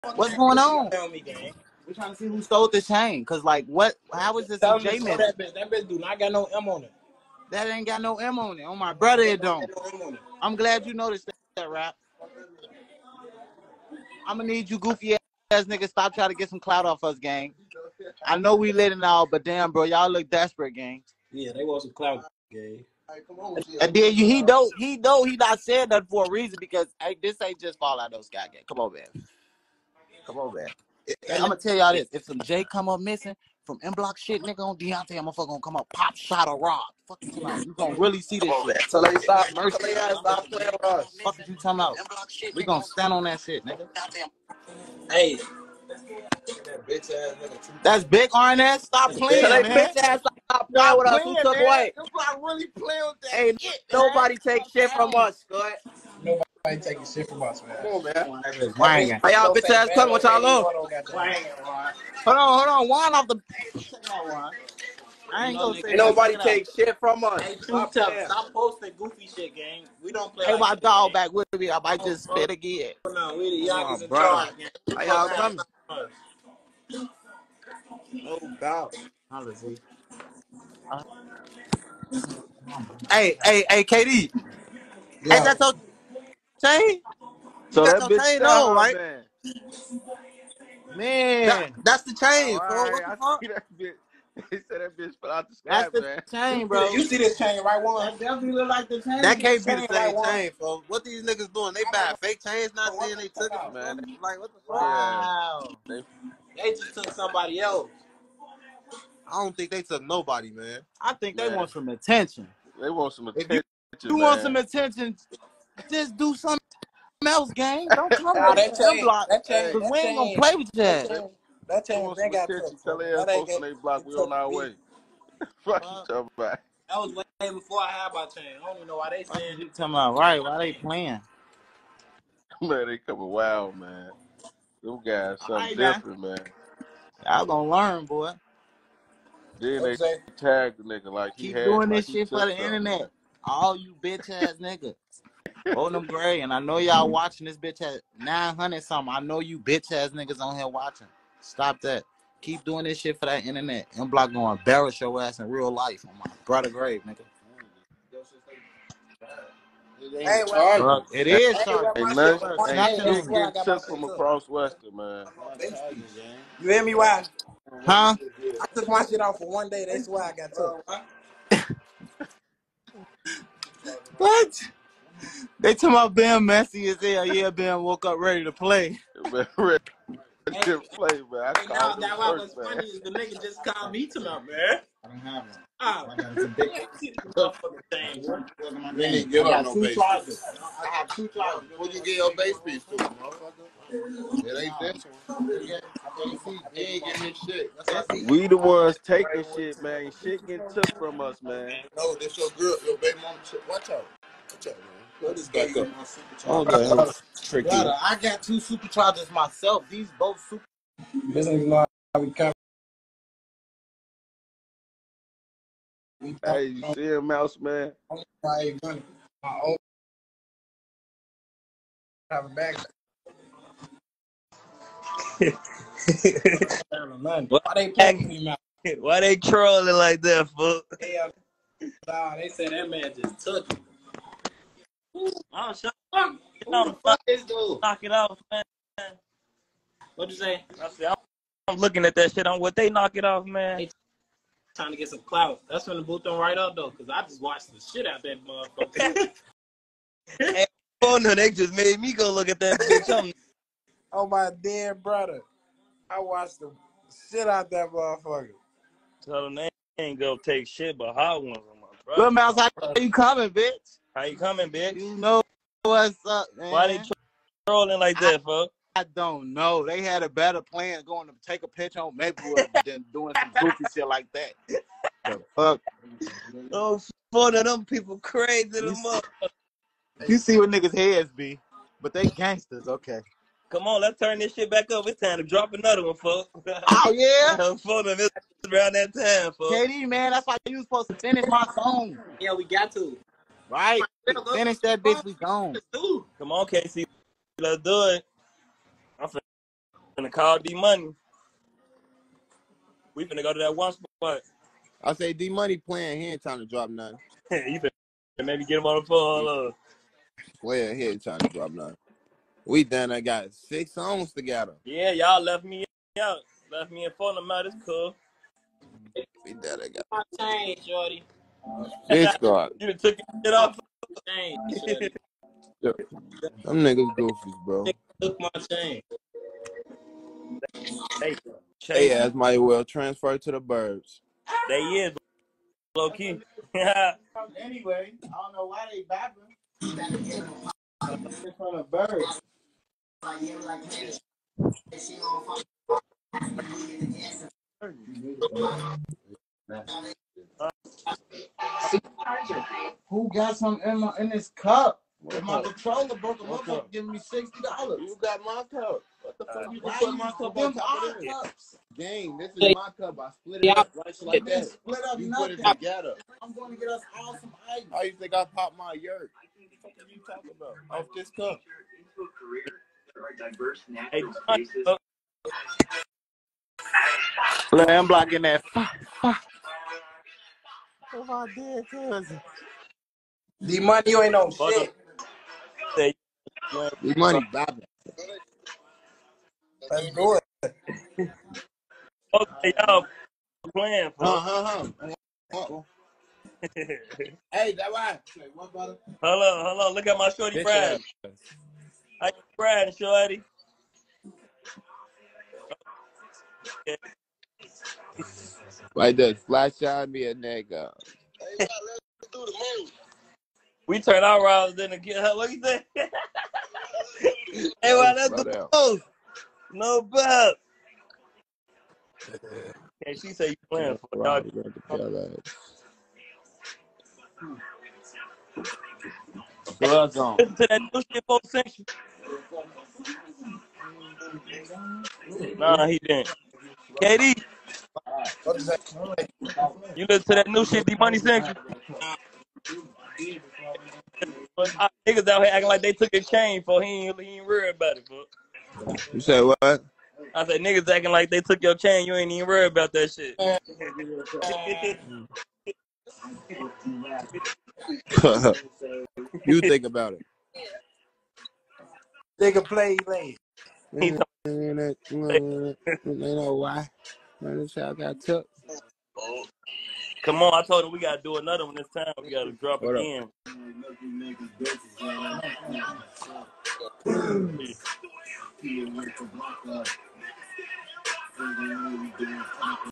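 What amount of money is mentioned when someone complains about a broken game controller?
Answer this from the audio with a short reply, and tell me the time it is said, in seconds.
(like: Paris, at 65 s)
$60, at 357 s.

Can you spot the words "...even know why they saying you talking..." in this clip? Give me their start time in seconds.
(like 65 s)
128 s.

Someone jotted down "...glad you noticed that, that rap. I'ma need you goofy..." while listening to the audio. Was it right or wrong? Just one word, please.
right.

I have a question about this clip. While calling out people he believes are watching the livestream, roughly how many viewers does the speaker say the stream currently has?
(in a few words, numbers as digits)
900 something.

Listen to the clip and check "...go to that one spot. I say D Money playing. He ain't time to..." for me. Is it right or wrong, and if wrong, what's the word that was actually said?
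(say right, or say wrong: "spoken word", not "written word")
right.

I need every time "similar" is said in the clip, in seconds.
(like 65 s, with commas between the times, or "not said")
not said.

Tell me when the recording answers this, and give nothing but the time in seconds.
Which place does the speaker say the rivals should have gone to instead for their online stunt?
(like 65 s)
272 s.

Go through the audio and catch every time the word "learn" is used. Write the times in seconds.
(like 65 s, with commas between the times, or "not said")
137 s.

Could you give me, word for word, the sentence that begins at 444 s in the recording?
Ah, niggas out here acting like they took a chain for he ain't, he ain't worried about it, bro.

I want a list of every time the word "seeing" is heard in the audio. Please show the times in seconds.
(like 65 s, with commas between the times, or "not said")
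not said.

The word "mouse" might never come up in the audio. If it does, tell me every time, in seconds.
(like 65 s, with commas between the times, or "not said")
217 s, 228 s, 262 s.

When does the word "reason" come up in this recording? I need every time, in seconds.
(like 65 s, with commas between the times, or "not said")
26 s.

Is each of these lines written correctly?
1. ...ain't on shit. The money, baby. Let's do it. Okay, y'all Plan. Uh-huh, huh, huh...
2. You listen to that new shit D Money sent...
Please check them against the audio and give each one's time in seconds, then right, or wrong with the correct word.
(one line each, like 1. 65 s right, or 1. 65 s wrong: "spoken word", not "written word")
1. 384 s right
2. 439 s right.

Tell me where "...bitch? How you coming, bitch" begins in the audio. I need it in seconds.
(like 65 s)
263 s.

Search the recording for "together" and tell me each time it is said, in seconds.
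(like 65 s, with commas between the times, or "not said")
314 s, 365 s.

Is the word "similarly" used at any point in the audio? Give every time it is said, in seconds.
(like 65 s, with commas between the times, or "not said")
not said.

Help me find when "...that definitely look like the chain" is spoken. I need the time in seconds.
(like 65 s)
98 s.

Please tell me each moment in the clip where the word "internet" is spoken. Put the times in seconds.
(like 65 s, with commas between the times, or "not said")
142 s, 153 s.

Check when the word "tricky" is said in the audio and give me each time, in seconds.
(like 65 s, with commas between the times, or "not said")
207 s.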